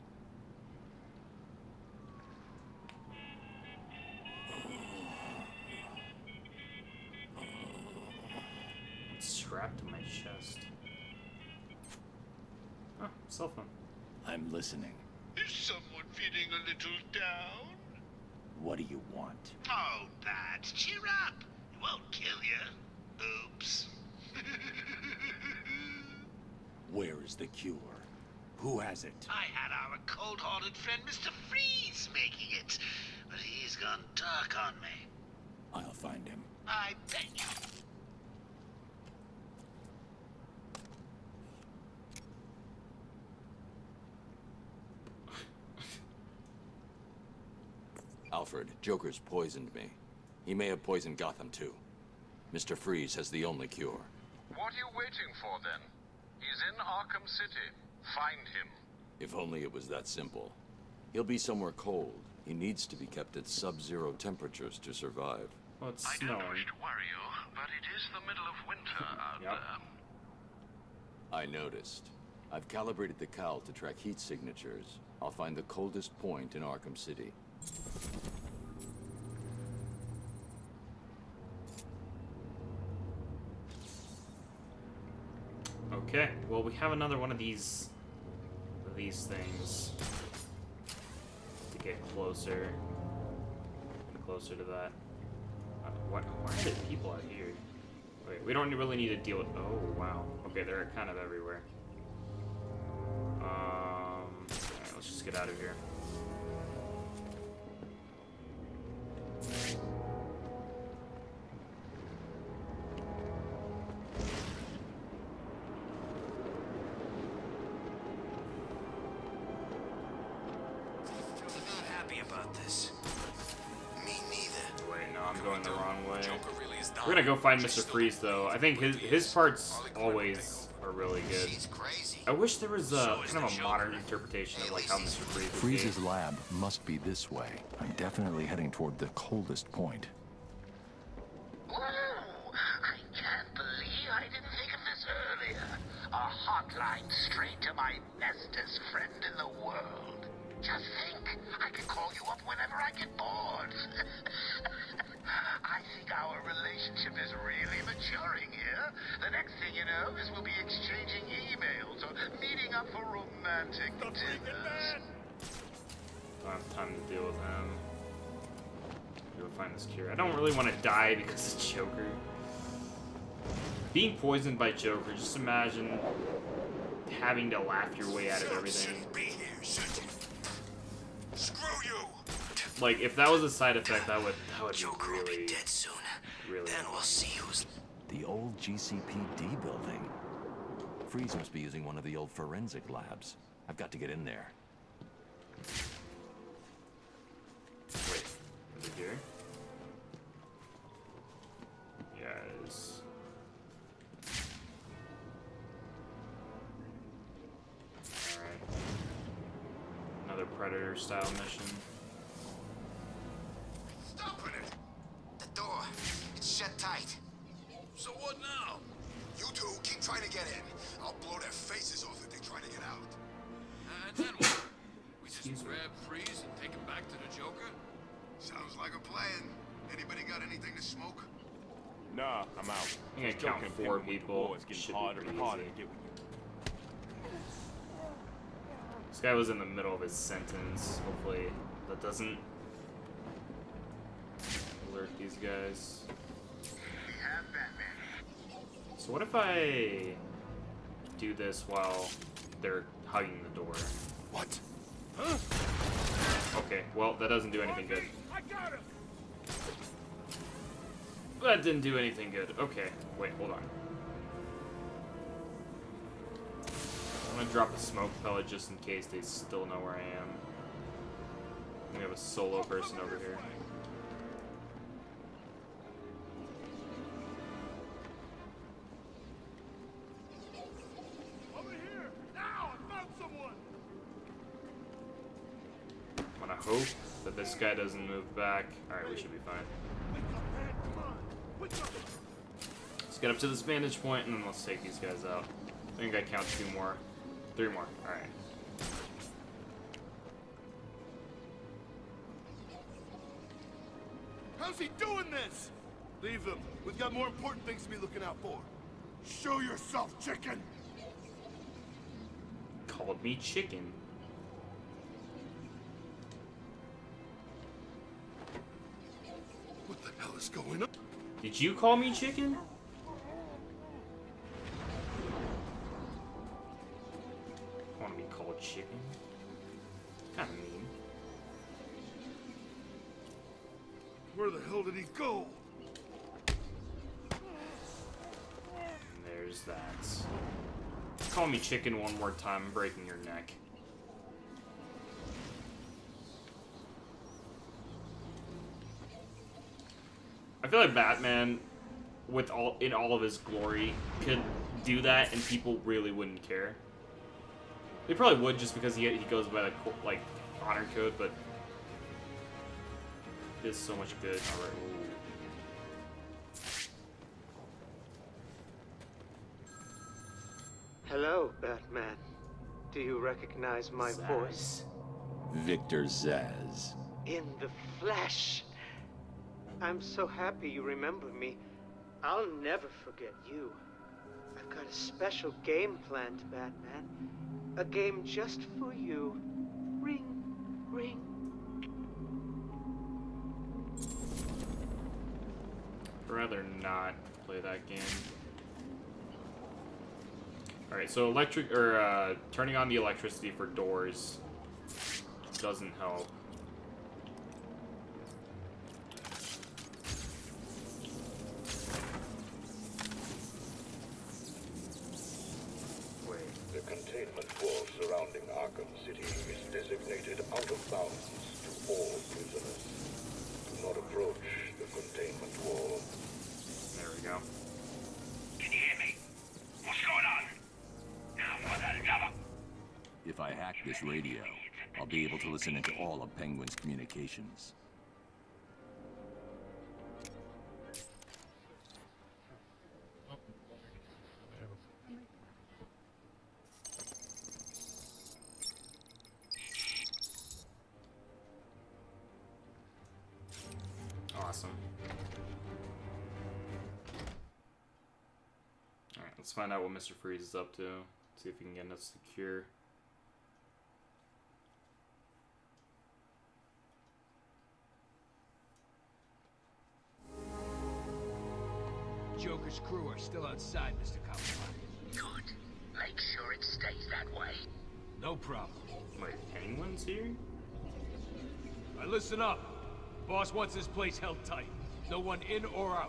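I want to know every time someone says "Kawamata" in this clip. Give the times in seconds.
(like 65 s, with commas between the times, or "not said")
474 s.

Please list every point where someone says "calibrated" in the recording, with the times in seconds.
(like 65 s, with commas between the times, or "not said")
72 s.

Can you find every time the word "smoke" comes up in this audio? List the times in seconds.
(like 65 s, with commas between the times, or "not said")
230 s, 267 s.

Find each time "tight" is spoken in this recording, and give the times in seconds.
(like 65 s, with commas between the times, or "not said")
216 s, 484 s.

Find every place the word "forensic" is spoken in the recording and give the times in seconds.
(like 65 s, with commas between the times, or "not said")
192 s.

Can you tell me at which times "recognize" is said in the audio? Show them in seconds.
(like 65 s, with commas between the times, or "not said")
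373 s.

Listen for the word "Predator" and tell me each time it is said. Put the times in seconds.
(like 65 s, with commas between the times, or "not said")
210 s.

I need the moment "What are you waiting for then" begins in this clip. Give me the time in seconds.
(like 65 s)
54 s.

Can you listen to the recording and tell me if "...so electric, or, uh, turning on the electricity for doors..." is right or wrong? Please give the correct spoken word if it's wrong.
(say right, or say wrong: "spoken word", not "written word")
right.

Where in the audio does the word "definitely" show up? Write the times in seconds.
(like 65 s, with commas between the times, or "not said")
137 s.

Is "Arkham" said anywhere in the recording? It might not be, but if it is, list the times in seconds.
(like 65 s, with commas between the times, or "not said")
56 s, 76 s.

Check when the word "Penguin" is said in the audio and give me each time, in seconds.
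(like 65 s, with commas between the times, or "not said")
436 s, 479 s.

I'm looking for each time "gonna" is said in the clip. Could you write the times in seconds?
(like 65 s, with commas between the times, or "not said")
127 s, 267 s.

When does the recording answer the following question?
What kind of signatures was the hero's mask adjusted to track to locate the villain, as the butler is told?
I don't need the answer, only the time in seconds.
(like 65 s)
73 s.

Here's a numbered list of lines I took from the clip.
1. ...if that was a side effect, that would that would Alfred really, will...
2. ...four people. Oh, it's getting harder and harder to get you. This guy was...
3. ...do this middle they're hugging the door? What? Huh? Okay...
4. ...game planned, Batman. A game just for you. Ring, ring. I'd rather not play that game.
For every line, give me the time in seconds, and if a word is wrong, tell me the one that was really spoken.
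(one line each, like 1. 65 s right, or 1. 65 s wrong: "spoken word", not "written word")
1. 182 s wrong: "Joker", not "Alfred"
2. 233 s right
3. 251 s wrong: "while", not "middle"
4. 385 s right.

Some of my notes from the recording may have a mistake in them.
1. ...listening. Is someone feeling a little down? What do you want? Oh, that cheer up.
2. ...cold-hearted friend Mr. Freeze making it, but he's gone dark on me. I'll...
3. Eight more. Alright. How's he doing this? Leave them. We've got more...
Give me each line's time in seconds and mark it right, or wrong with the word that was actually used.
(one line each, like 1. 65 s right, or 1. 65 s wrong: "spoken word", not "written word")
1. 14 s right
2. 30 s right
3. 297 s wrong: "Three", not "Eight".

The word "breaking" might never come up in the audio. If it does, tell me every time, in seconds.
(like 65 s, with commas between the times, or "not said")
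342 s.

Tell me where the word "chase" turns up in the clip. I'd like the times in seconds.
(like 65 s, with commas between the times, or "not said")
not said.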